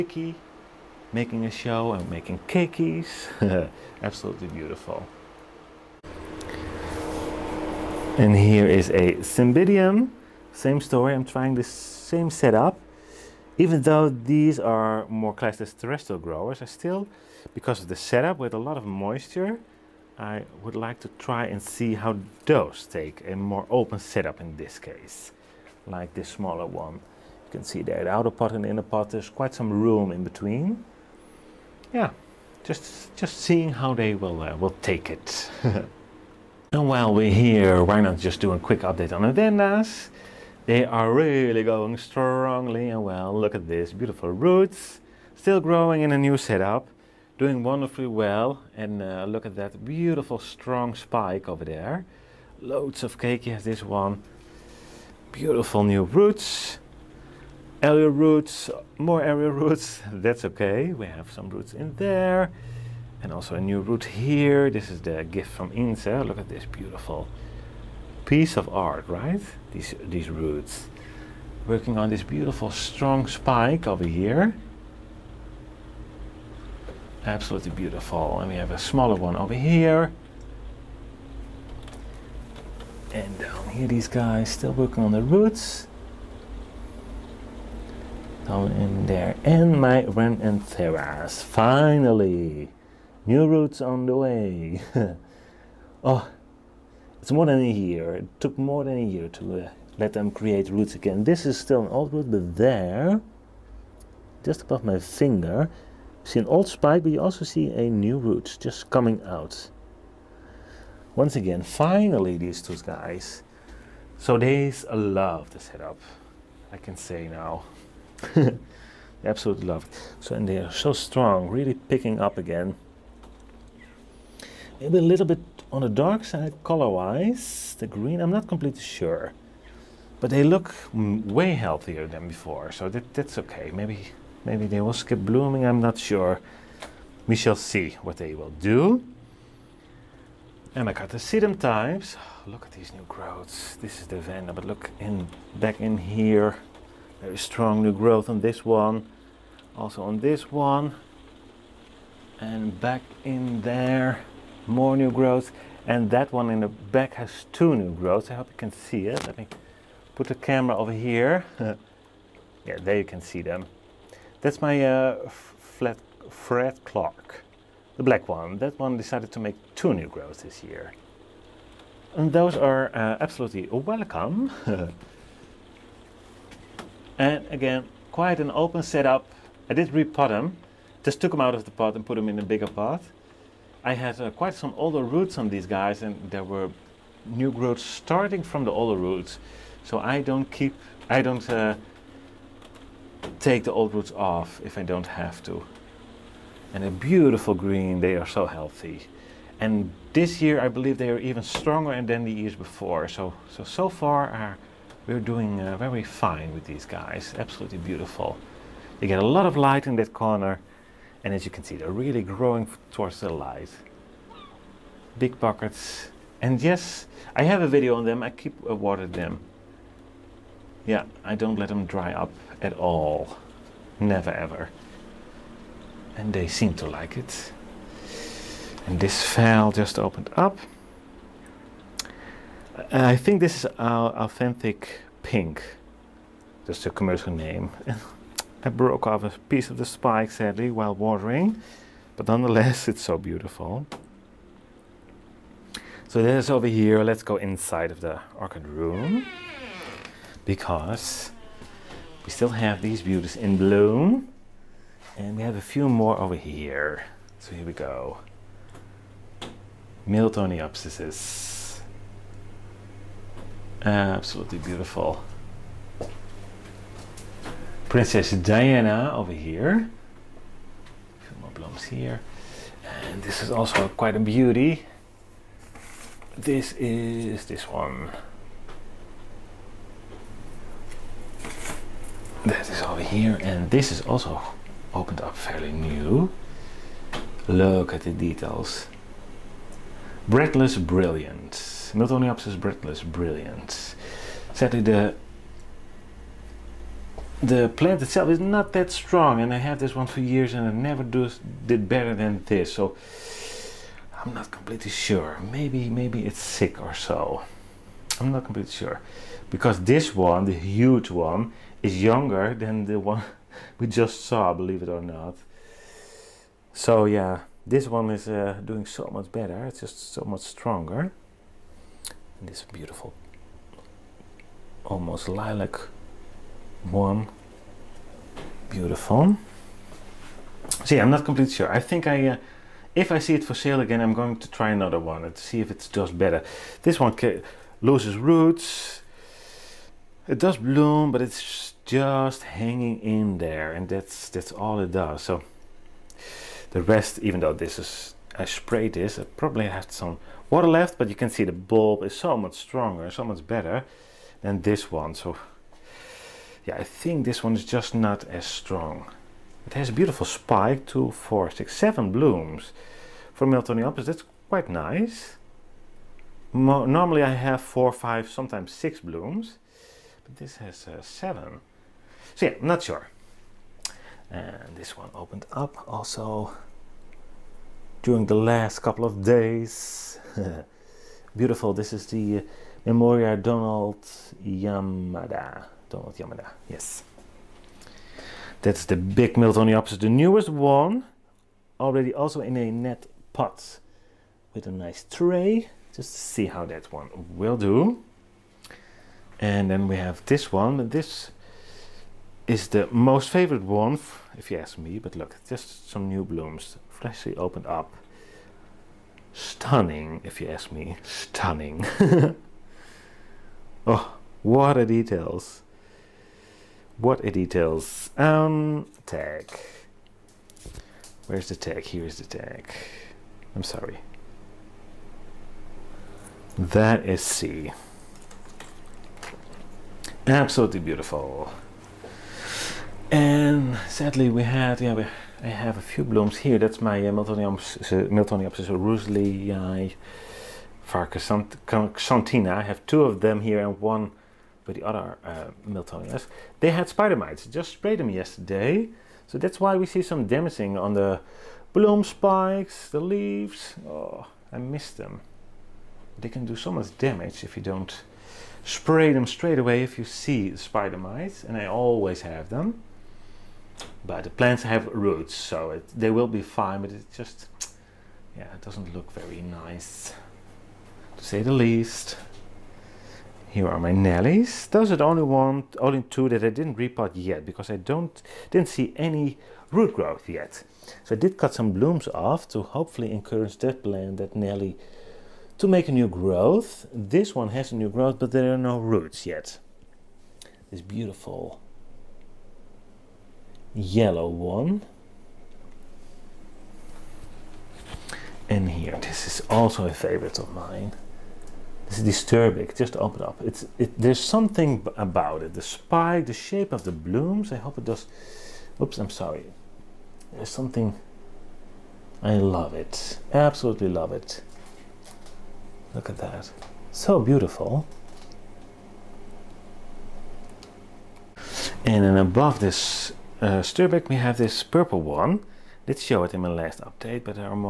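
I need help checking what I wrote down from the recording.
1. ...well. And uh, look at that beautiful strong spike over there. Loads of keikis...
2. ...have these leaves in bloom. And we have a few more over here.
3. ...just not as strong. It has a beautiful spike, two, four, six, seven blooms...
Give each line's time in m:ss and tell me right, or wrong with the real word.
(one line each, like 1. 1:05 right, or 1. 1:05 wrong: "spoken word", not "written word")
1. 0:48 right
2. 4:12 wrong: "beauties", not "leaves"
3. 5:57 right.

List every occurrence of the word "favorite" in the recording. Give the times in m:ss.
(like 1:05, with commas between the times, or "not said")
6:43, 8:19.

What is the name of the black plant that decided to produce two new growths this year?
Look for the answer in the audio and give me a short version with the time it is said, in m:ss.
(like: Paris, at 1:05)
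Fred Clark, at 2:46.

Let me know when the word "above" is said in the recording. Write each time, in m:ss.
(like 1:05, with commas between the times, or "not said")
1:44, 8:42.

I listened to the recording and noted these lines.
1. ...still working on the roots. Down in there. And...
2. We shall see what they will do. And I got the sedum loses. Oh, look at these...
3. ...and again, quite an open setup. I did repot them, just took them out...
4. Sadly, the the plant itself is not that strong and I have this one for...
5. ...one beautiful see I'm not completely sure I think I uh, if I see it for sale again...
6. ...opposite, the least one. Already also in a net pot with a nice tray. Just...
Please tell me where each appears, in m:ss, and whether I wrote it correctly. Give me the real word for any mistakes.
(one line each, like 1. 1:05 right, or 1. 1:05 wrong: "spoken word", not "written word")
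1. 1:24 right
2. 2:17 wrong: "types", not "loses"
3. 2:57 right
4. 4:54 right
5. 5:26 right
6. 6:29 wrong: "newest", not "least".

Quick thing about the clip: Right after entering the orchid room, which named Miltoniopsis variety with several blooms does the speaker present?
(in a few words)
Princess Diana.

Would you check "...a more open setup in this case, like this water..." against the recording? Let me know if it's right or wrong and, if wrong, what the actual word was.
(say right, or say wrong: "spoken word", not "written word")
wrong: "smaller", not "water".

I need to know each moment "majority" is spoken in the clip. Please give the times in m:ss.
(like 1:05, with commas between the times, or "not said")
not said.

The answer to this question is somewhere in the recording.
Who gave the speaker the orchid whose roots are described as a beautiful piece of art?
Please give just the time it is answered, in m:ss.
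1:05.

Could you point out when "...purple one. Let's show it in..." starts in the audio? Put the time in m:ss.
8:44.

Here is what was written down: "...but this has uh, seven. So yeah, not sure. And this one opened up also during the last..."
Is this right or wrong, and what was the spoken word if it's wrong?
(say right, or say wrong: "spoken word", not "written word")
right.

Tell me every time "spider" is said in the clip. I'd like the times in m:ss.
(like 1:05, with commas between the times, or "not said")
7:26, 7:40.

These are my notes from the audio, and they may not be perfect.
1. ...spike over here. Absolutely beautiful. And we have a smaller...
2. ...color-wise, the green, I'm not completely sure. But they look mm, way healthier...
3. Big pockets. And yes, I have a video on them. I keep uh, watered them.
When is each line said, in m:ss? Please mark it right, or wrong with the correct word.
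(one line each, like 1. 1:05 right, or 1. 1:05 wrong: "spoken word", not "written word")
1. 1:13 right
2. 2:06 right
3. 3:35 right.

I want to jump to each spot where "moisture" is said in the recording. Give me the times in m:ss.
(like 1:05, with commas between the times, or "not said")
0:18.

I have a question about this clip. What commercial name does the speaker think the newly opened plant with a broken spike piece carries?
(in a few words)
authentic pink.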